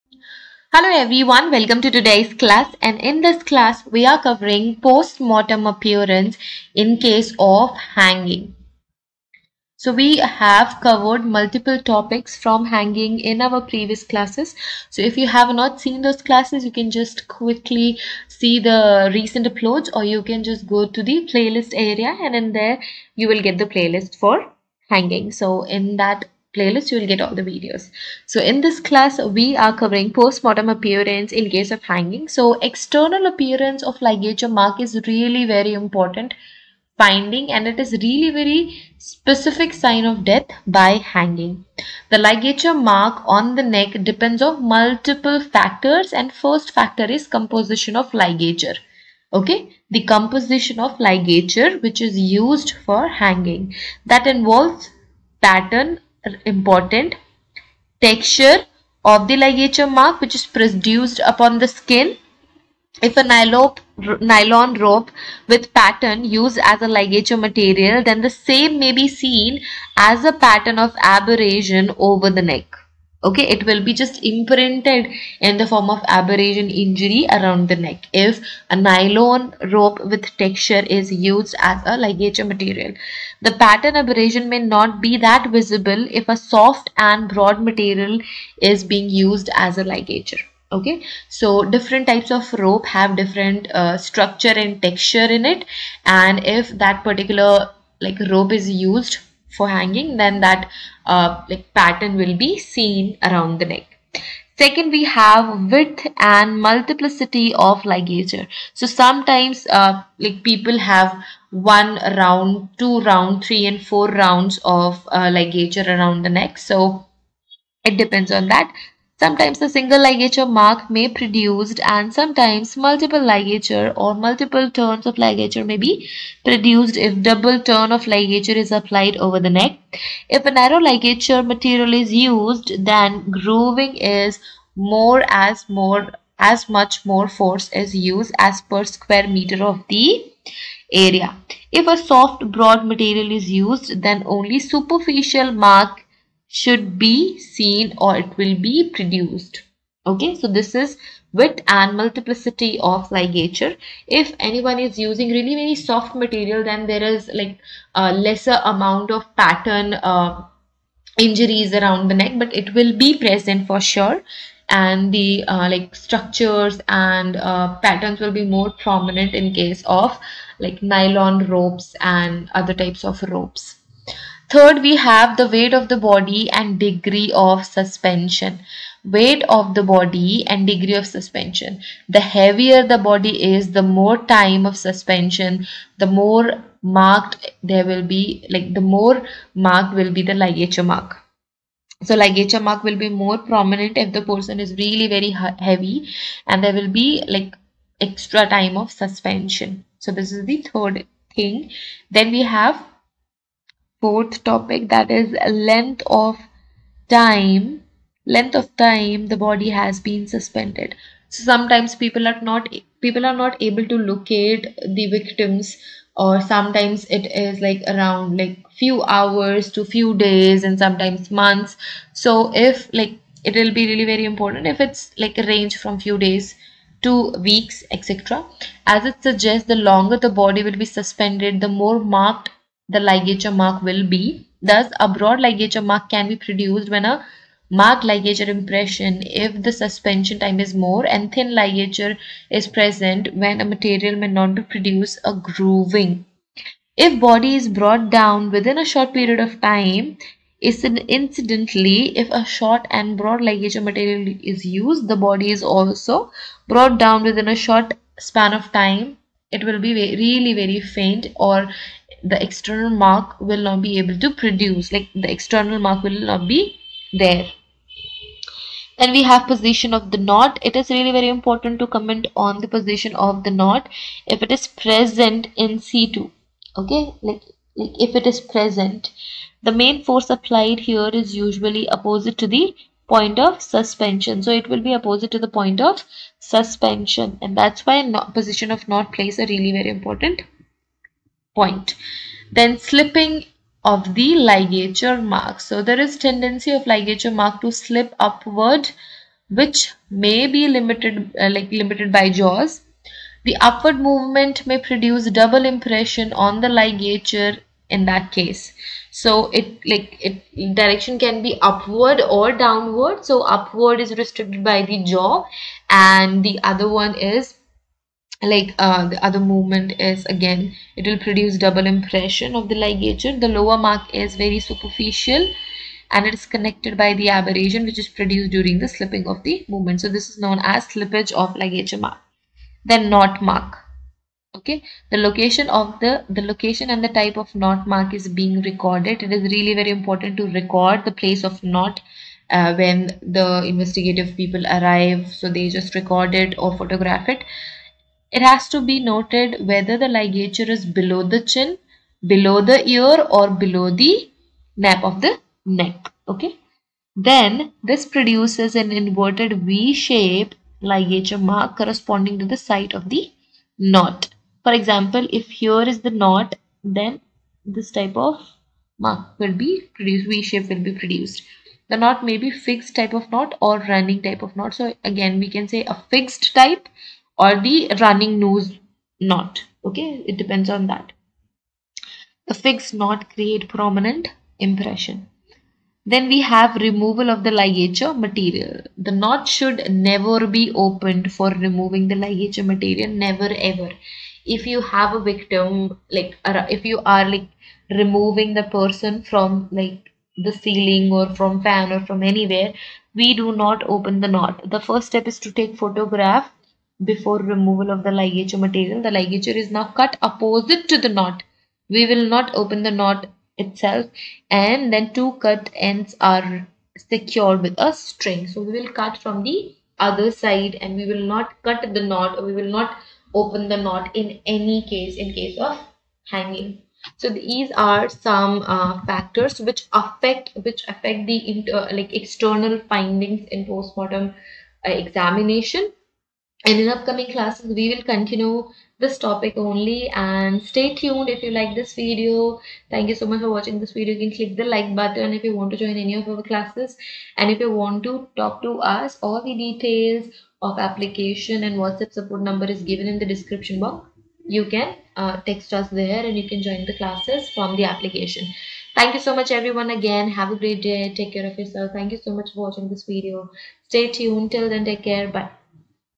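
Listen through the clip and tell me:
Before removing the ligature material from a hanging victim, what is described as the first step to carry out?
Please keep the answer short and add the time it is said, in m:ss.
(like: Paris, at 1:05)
Take photograph, at 6:45.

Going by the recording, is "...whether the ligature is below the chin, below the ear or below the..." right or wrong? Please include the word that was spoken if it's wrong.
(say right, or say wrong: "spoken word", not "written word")
right.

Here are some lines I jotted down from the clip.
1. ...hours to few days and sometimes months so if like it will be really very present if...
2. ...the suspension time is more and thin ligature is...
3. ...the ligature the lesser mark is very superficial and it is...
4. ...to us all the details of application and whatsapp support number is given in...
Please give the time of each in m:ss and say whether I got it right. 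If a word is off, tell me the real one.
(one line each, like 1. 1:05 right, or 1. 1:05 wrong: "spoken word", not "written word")
1. 3:39 wrong: "important", not "present"
2. 3:59 right
3. 5:22 wrong: "lower", not "lesser"
4. 7:28 right.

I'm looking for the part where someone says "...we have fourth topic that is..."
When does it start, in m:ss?
3:22.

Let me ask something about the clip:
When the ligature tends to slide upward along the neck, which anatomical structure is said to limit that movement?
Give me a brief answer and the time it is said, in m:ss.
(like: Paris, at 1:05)
Jaws, at 5:02.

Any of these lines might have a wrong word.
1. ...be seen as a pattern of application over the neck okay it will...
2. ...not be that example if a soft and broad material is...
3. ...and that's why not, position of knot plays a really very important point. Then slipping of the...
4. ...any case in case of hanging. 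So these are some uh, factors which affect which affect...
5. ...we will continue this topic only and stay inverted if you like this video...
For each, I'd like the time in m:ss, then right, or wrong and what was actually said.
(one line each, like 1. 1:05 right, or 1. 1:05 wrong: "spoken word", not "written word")
1. 1:08 wrong: "abrasion", not "application"
2. 1:24 wrong: "visible", not "example"
3. 4:47 right
4. 7:04 right
5. 7:17 wrong: "tuned", not "inverted".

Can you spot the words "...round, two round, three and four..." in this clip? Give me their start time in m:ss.
1:52.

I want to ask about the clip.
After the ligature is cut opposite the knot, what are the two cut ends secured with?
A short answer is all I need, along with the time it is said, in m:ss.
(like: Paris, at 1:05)
A string, at 6:57.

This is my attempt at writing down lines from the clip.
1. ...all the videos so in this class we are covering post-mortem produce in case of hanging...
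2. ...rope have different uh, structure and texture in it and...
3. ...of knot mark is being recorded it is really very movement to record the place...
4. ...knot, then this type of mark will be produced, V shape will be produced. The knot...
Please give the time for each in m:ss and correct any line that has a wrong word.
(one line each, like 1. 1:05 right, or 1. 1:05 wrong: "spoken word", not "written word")
1. 0:27 wrong: "appearance", not "produce"
2. 1:32 right
3. 5:37 wrong: "important", not "movement"
4. 6:06 right.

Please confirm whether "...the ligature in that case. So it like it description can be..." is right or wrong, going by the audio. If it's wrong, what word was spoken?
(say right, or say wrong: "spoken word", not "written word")
wrong: "direction", not "description".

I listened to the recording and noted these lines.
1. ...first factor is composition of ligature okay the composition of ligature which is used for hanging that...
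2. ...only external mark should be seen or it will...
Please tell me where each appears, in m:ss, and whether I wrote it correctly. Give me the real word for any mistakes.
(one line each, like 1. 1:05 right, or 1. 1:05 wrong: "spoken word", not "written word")
1. 0:46 right
2. 2:24 wrong: "superficial", not "external".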